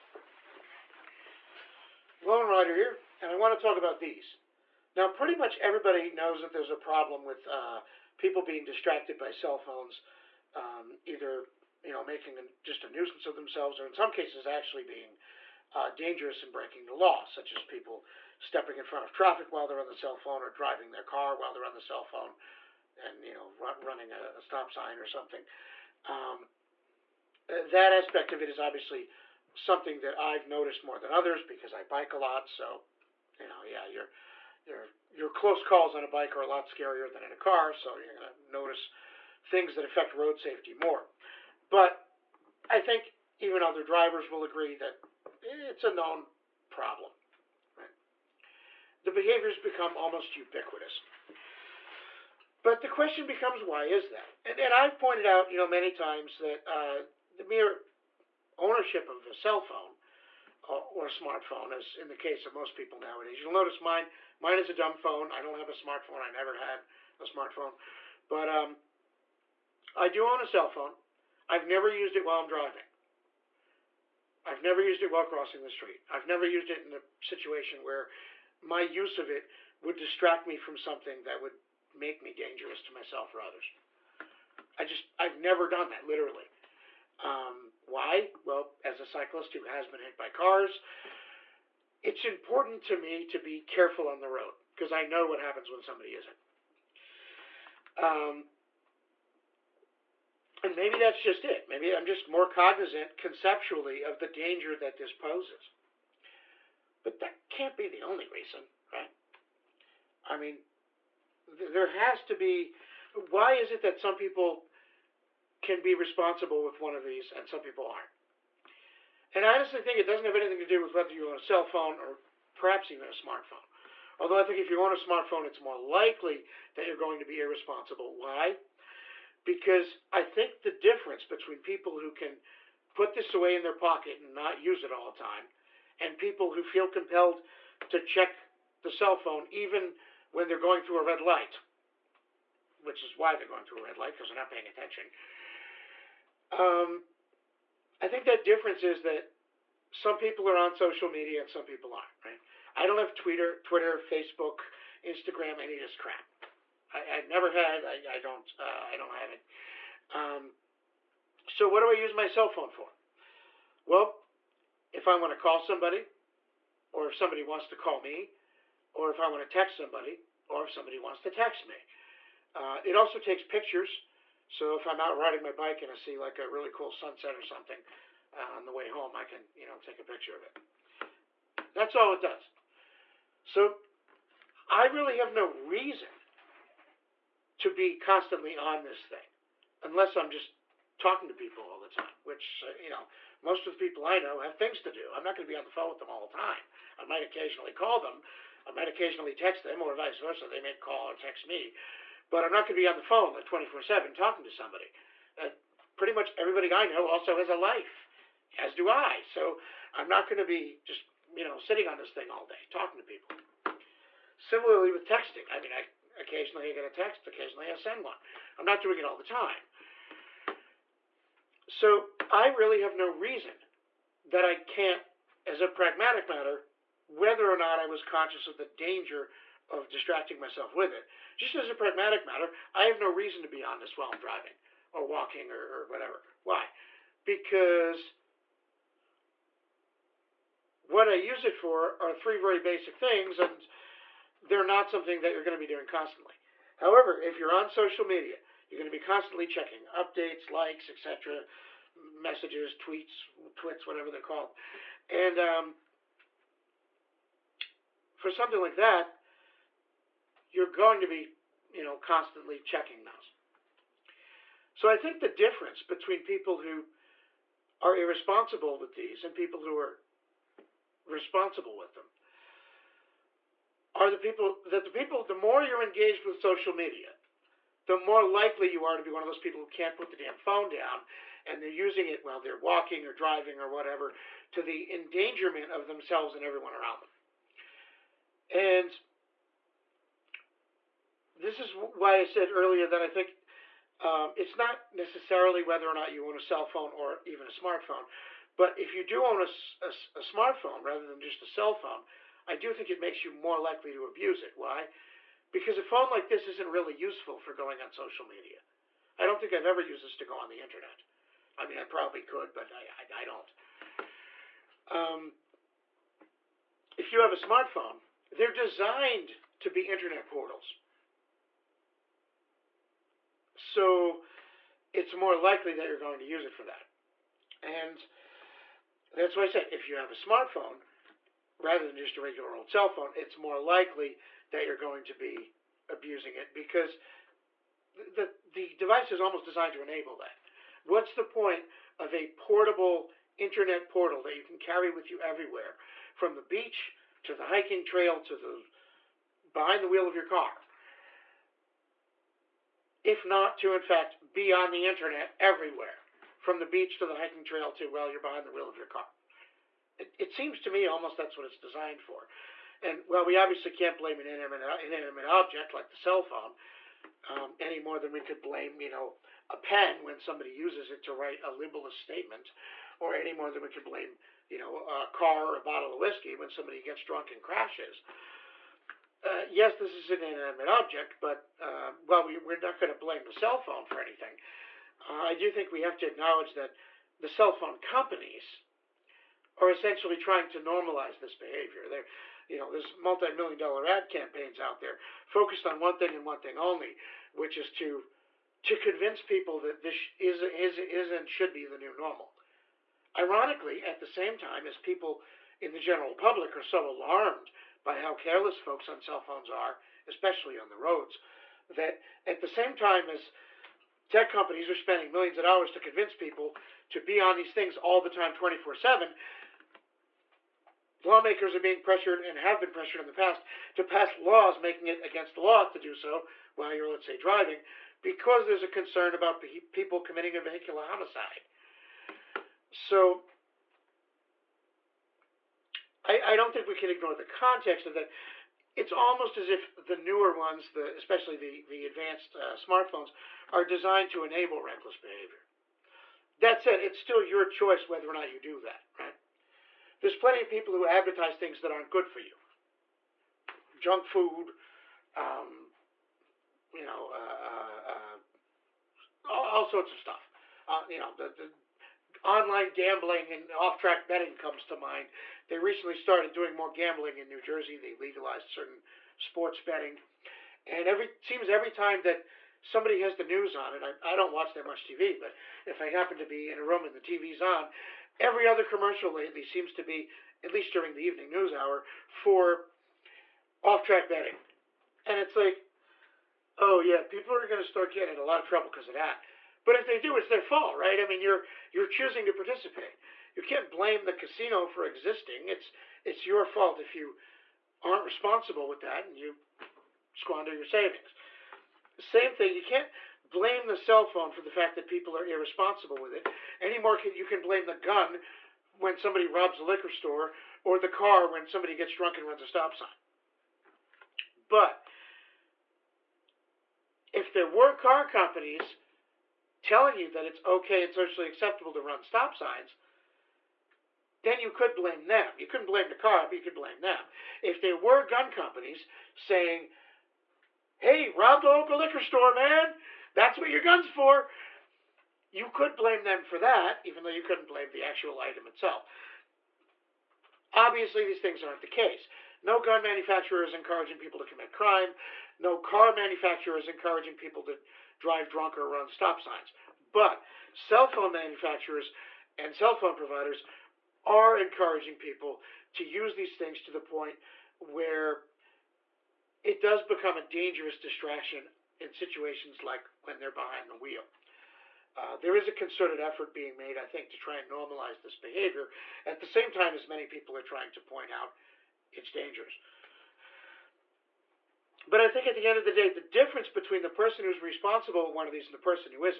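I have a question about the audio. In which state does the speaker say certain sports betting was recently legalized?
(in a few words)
New Jersey.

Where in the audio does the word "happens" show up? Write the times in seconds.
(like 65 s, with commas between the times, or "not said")
95 s, 475 s.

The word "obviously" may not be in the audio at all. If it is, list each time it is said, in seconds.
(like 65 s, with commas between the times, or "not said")
28 s, 363 s, 540 s.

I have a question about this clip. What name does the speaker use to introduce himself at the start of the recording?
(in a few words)
Lone Rider.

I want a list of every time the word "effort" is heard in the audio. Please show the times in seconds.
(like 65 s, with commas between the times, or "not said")
565 s.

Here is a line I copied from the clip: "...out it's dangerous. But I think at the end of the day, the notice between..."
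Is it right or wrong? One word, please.
wrong.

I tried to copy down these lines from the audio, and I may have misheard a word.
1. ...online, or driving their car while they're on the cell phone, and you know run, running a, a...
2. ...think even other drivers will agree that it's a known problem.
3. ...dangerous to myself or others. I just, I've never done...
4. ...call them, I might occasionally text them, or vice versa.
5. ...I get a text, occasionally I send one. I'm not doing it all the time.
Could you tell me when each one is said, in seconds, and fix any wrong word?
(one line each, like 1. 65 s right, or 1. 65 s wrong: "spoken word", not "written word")
1. 20 s wrong: "phone", not "online"
2. 42 s right
3. 82 s right
4. 197 s right
5. 216 s right.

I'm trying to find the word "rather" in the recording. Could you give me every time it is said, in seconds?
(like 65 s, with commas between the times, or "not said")
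300 s, 331 s.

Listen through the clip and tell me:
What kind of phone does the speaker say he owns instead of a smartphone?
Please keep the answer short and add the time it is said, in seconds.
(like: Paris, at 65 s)
dumb phone, at 64 s.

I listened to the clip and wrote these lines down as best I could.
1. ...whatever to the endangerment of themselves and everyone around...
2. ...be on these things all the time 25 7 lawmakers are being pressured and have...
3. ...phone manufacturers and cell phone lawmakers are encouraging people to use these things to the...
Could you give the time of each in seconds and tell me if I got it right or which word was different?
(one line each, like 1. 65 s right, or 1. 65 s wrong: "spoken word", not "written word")
1. 283 s right
2. 416 s wrong: "24", not "25"
3. 550 s wrong: "providers", not "lawmakers".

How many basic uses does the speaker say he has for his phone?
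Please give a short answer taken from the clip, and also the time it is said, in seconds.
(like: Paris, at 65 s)
3, at 242 s.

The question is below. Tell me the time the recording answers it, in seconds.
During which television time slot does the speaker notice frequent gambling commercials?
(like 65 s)
481 s.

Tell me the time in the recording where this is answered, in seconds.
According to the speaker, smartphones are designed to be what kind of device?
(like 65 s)
319 s.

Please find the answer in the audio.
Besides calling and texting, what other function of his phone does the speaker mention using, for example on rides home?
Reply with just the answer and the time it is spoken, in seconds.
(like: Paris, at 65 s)
takes pictures, at 173 s.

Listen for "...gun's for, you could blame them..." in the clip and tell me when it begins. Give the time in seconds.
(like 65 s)
533 s.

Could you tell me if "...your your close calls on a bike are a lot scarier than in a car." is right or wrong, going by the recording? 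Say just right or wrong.
right.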